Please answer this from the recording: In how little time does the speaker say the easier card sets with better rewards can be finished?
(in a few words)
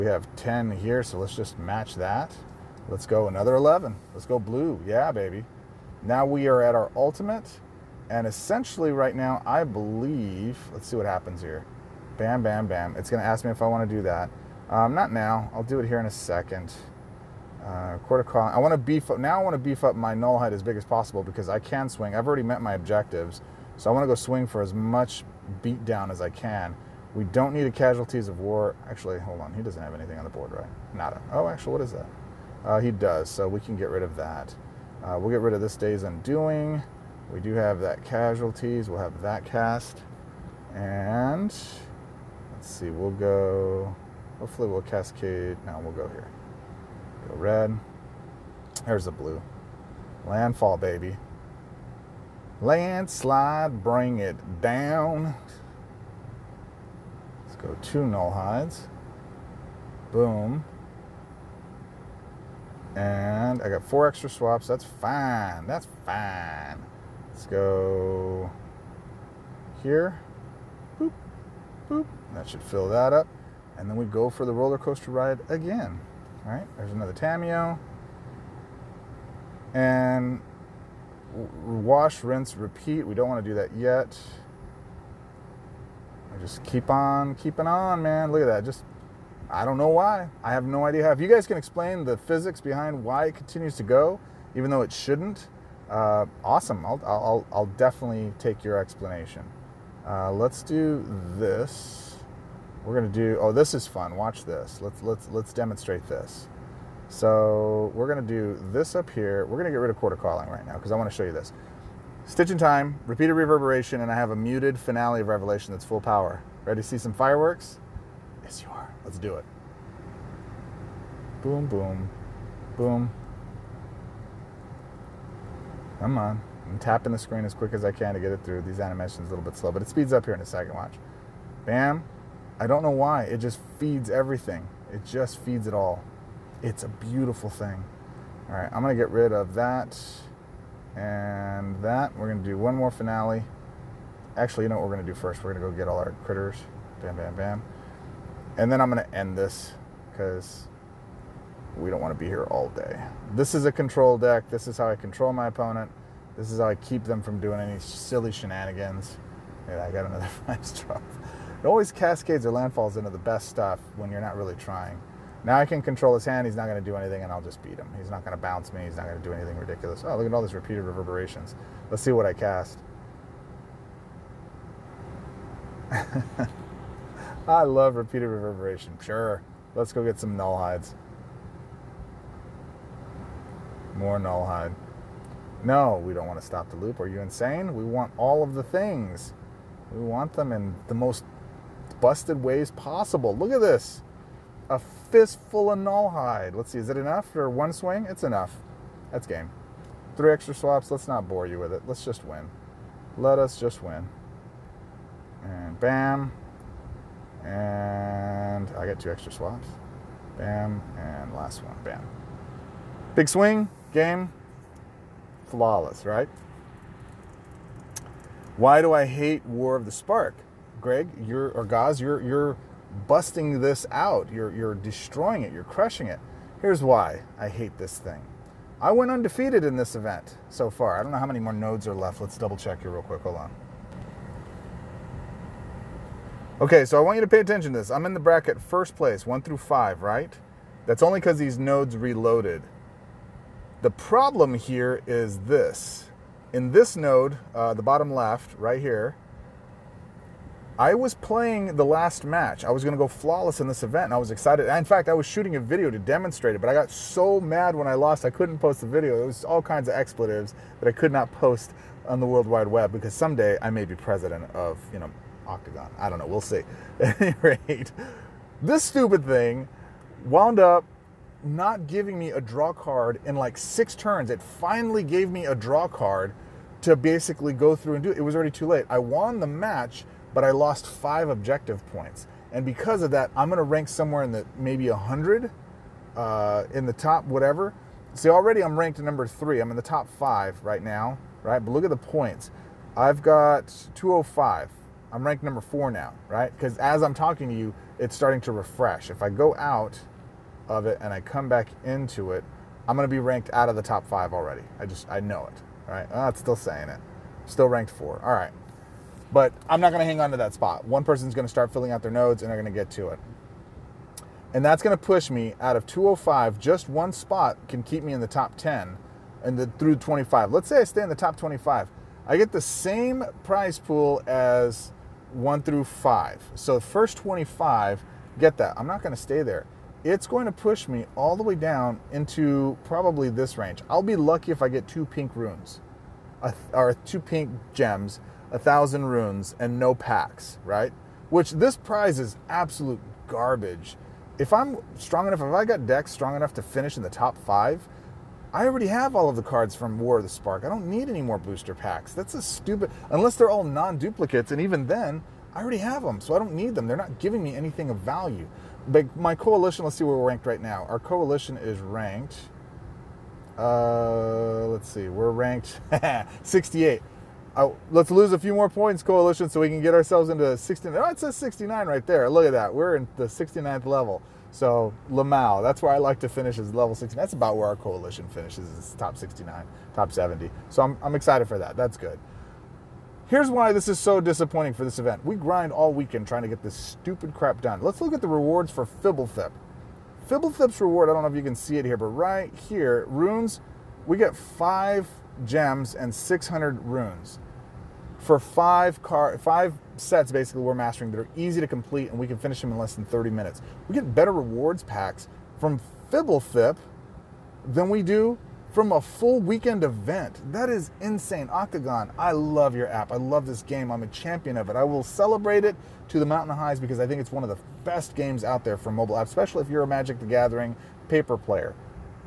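less than 30 minutes.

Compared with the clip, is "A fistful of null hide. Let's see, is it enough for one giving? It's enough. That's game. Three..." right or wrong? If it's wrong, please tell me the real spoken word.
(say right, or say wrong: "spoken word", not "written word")
wrong: "swing", not "giving".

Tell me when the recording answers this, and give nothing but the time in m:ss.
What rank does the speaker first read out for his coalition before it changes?
6:06.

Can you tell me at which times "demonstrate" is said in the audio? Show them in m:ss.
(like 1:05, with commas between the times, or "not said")
1:45, 4:15.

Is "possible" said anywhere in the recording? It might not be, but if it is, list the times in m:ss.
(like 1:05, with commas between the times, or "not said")
0:20, 3:12.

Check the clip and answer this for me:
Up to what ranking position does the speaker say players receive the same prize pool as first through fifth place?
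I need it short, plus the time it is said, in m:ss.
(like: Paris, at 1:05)
25, at 5:26.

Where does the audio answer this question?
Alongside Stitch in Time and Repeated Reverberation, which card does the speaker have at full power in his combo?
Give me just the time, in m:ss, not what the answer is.
1:54.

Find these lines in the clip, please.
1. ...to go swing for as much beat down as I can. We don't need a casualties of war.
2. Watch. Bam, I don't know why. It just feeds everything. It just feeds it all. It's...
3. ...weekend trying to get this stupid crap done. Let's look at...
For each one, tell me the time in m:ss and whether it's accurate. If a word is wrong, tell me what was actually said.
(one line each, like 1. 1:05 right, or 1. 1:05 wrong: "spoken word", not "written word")
1. 0:24 right
2. 2:10 right
3. 6:25 right.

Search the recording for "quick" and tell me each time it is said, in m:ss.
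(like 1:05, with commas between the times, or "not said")
2:07, 3:53.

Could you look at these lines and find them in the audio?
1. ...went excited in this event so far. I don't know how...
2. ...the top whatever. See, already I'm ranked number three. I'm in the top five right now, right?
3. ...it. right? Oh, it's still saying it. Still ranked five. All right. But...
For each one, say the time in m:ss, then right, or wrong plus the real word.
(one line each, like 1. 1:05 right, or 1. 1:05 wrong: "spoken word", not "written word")
1. 3:48 wrong: "undefeated", not "excited"
2. 4:46 right
3. 5:05 wrong: "four", not "five".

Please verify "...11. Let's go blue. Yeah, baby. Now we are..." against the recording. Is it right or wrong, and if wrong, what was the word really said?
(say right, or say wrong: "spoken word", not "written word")
right.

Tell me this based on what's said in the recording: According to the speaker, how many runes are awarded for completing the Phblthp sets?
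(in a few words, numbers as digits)
600.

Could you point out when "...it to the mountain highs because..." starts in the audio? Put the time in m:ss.
6:55.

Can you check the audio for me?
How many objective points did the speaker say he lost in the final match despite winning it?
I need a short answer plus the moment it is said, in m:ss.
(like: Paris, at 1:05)
5, at 4:40.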